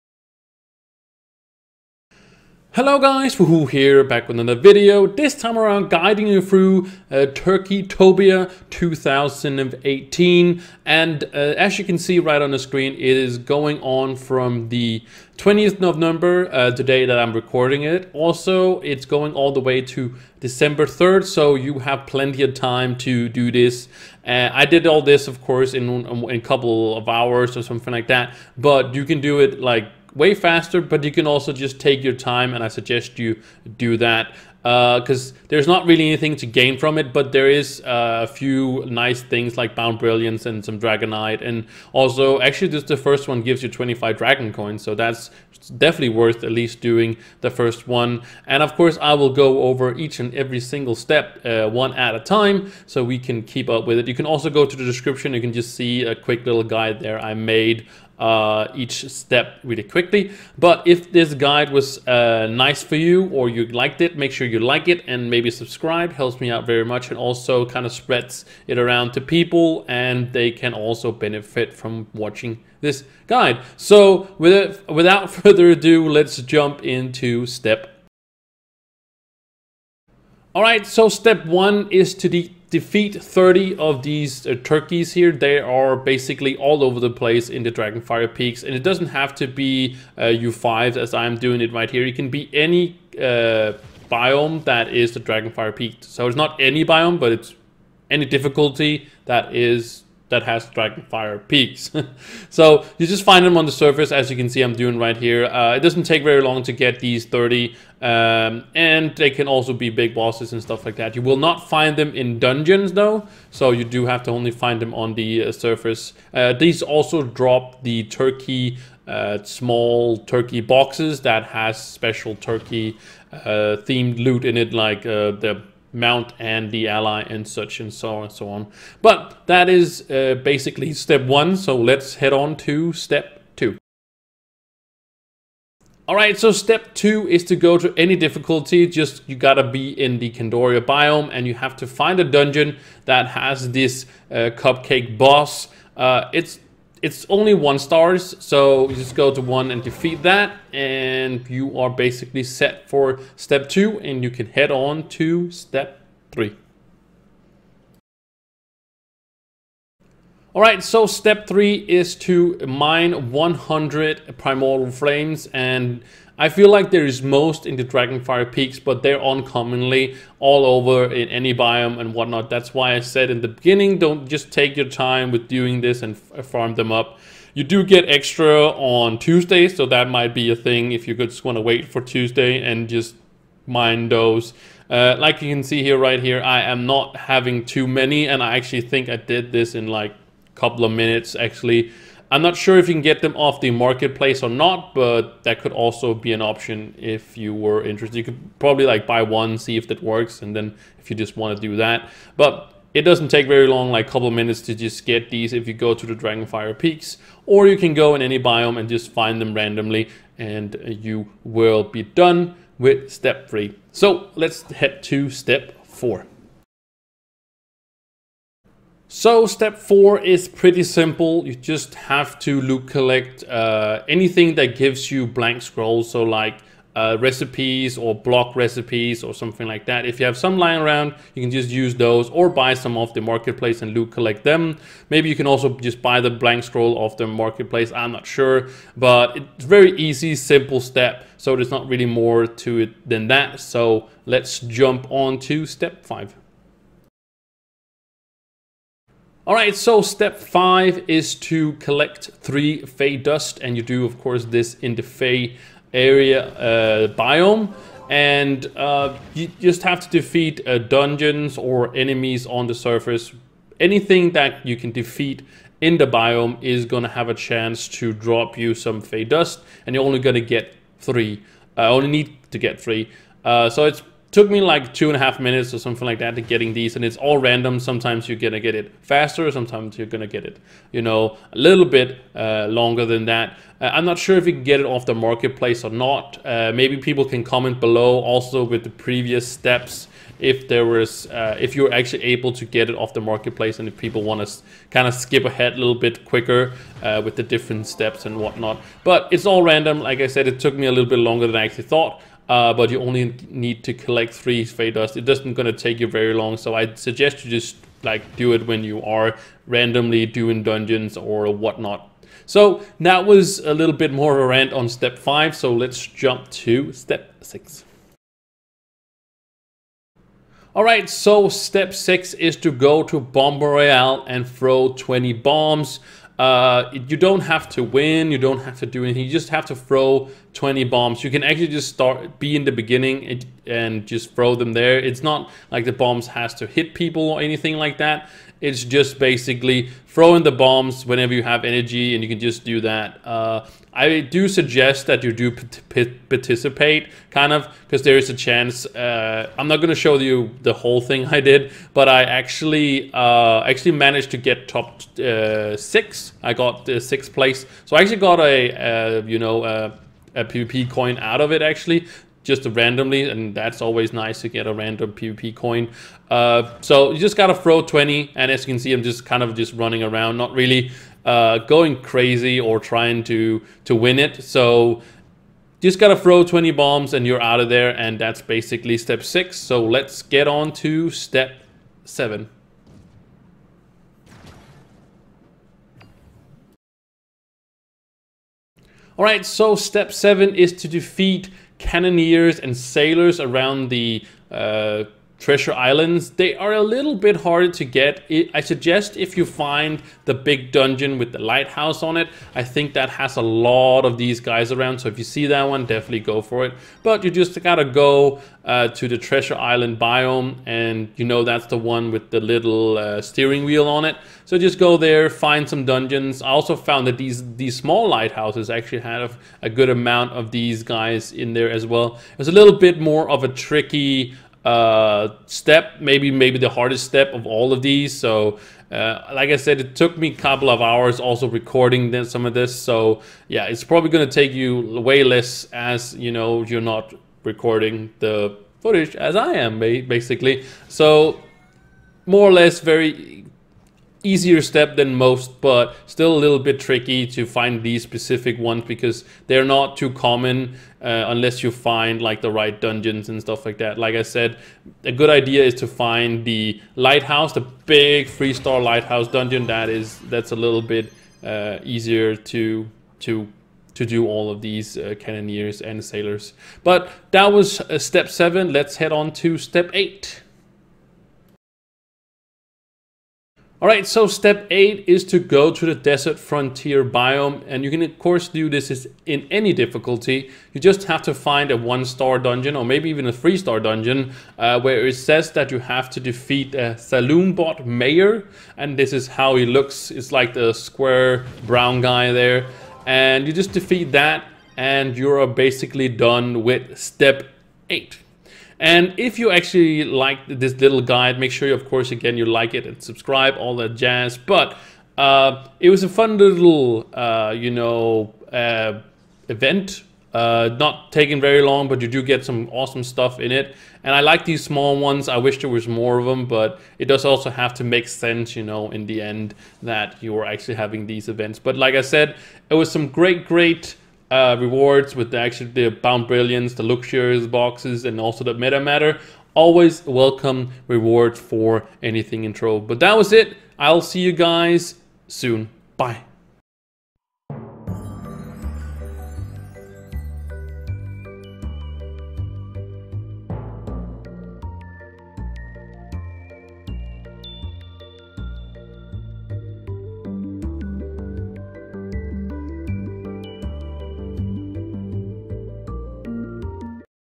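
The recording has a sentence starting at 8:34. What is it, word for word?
And I like these small ones.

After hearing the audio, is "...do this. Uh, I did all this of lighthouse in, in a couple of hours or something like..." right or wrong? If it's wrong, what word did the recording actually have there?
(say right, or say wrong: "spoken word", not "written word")
wrong: "course", not "lighthouse".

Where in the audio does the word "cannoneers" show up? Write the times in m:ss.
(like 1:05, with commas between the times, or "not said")
6:31, 7:45.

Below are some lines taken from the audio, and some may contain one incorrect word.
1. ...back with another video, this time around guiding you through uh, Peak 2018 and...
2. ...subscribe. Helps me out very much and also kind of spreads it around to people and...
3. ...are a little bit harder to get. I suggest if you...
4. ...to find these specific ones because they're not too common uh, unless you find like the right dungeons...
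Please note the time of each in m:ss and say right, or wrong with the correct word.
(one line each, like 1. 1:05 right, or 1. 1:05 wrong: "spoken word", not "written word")
1. 0:04 wrong: "Turkeytopia", not "Peak"
2. 1:05 right
3. 6:36 right
4. 7:27 right.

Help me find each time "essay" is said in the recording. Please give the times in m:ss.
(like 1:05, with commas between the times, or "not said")
not said.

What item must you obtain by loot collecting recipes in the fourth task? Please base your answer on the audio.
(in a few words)
Blank scrolls.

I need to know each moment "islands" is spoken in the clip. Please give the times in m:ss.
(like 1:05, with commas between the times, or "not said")
6:35, 6:49.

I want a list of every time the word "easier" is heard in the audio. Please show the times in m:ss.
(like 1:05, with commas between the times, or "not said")
7:24, 7:41.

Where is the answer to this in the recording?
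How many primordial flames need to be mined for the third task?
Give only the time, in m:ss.
2:43.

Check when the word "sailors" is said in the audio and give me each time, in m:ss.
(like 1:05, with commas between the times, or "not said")
6:32, 7:46.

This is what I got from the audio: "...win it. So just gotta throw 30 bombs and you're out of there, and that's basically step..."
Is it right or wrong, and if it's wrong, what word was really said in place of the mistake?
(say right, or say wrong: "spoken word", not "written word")
wrong: "20", not "30".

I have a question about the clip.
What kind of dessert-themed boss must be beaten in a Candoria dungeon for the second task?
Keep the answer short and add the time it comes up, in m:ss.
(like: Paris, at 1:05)
Cupcake boss, at 2:24.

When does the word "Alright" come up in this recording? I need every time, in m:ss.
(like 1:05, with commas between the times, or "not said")
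5:20, 6:29.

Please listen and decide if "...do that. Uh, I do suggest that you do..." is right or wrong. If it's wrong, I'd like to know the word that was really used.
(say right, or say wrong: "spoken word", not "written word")
right.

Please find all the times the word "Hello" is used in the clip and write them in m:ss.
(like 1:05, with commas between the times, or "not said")
0:02.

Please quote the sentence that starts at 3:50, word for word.
If you have some lying around, you can just use those or buy some off the marketplace and loot collect them.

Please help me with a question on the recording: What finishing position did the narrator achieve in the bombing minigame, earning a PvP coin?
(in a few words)
Sixth place.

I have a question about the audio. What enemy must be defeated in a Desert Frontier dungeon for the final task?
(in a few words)
Saloon bot mayor.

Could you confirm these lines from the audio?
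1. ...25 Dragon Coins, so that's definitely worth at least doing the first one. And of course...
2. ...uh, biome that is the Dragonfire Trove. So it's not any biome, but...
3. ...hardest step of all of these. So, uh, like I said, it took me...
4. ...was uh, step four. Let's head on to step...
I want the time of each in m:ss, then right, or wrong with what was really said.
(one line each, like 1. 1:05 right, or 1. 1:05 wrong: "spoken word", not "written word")
1. 0:43 right
2. 1:33 wrong: "Peak", not "Trove"
3. 7:06 right
4. 7:47 wrong: "seven", not "four".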